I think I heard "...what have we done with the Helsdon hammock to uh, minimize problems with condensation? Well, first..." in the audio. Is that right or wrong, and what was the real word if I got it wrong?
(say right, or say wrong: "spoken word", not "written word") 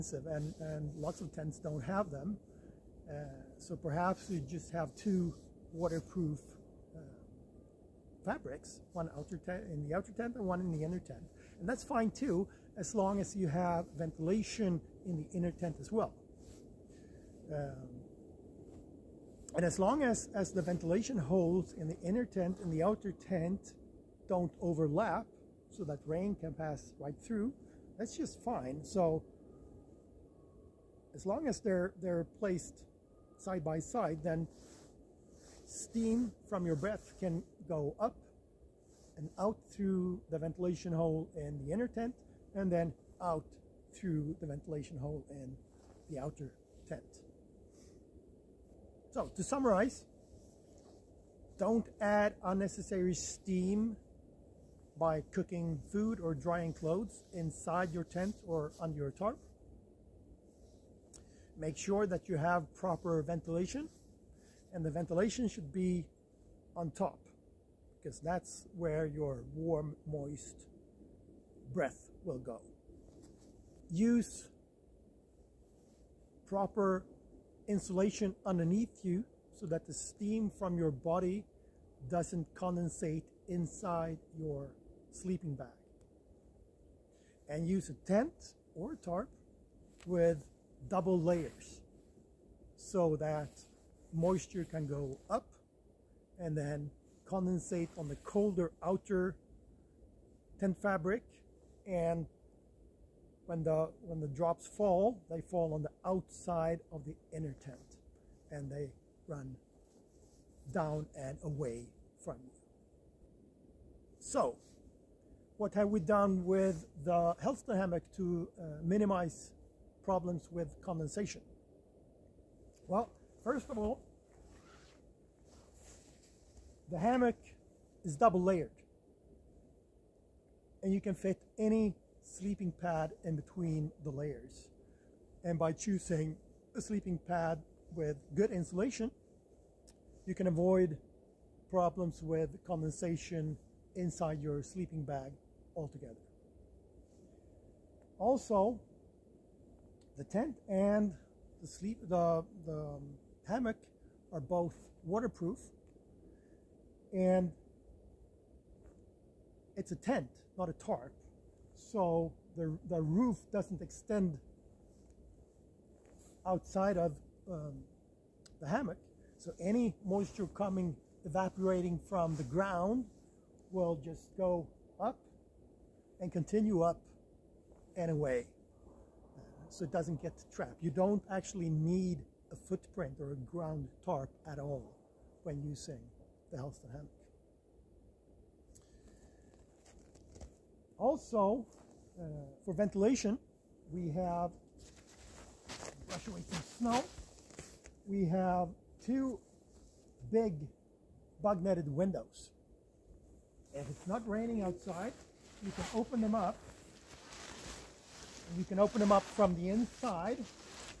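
right.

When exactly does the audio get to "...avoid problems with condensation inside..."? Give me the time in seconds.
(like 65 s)
140 s.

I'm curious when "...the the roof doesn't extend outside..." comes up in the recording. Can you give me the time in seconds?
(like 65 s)
162 s.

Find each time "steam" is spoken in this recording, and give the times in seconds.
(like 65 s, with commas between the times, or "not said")
35 s, 53 s, 79 s.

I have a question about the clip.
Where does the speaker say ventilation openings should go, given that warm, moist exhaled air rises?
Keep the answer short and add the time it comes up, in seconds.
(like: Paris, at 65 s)
On top, at 66 s.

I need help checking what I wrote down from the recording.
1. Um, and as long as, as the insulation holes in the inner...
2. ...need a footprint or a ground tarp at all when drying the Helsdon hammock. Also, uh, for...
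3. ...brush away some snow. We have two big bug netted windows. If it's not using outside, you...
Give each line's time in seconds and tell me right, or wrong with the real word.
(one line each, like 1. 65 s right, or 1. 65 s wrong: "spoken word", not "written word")
1. 17 s wrong: "ventilation", not "insulation"
2. 181 s wrong: "using", not "drying"
3. 196 s wrong: "raining", not "using".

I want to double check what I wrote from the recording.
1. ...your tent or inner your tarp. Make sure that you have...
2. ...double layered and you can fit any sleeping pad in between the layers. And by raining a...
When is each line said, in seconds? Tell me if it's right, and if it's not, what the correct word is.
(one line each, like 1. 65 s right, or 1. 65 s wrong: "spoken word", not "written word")
1. 57 s wrong: "under", not "inner"
2. 128 s wrong: "choosing", not "raining".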